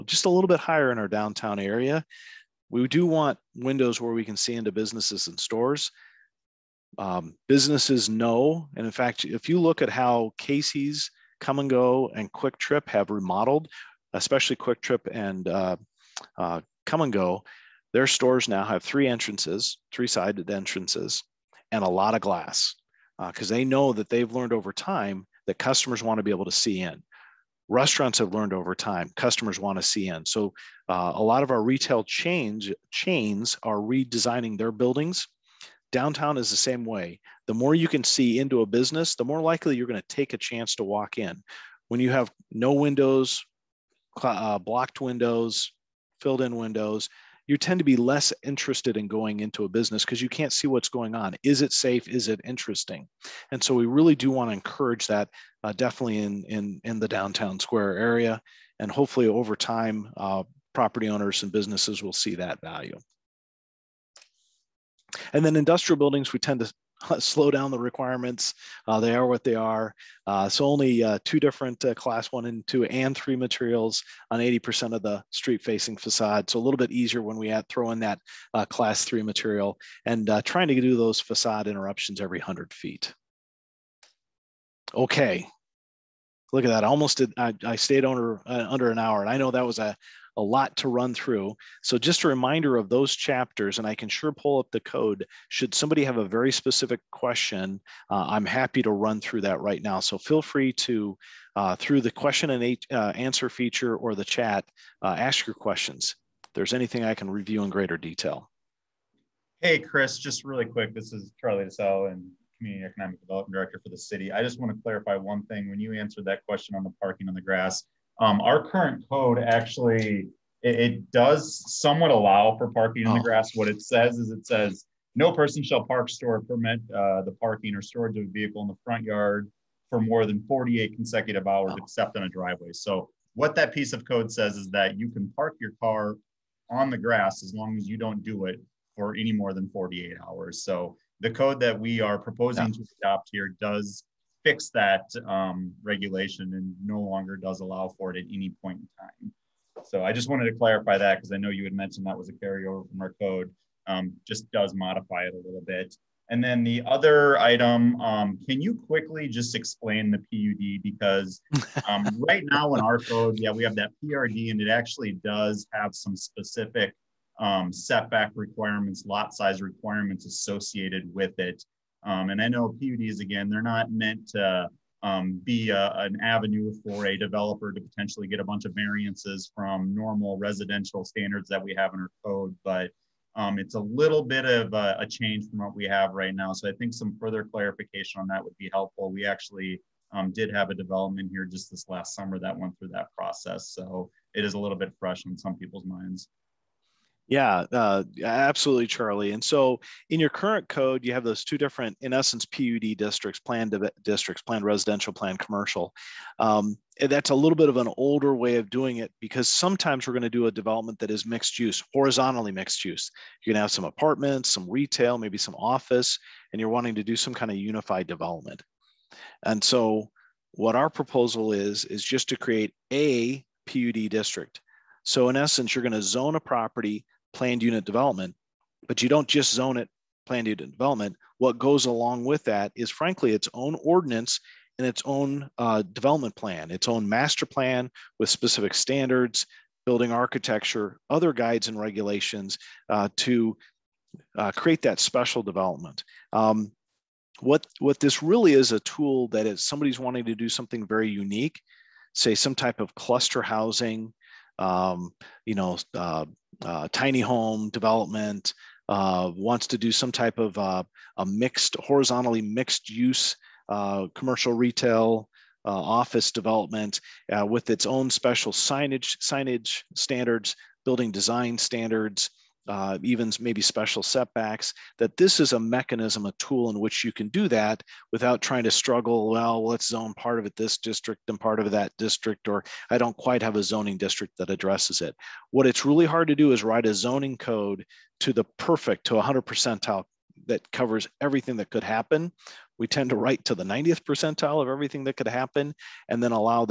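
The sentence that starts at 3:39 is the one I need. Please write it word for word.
And so what our proposal is, is just to create a PUD district.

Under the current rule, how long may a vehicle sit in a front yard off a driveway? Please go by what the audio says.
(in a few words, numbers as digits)
48 consecutive hours.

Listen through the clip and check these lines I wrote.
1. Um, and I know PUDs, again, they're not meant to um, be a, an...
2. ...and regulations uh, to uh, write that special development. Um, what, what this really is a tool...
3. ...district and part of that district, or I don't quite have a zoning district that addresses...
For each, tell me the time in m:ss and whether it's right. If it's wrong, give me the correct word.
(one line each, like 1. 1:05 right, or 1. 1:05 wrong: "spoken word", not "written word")
1. 2:52 right
2. 4:01 wrong: "create", not "write"
3. 4:40 right.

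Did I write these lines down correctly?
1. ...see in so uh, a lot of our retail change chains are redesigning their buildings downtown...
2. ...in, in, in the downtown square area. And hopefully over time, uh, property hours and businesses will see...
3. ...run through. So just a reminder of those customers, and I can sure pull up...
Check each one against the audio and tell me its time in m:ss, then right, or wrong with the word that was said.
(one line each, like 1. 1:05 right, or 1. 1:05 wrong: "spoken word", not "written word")
1. 0:29 right
2. 0:56 wrong: "owners", not "hours"
3. 1:30 wrong: "chapters", not "customers".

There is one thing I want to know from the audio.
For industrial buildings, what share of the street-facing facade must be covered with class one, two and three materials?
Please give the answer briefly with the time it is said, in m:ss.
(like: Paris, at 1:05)
80%, at 1:14.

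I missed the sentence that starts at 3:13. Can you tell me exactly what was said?
So it is a little bit fresh in some people's minds.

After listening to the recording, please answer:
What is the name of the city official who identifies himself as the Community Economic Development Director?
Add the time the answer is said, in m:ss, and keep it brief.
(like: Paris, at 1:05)
Charlie DeSalle, at 1:51.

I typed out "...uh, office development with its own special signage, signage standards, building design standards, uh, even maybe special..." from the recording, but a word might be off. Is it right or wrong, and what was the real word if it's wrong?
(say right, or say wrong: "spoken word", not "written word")
right.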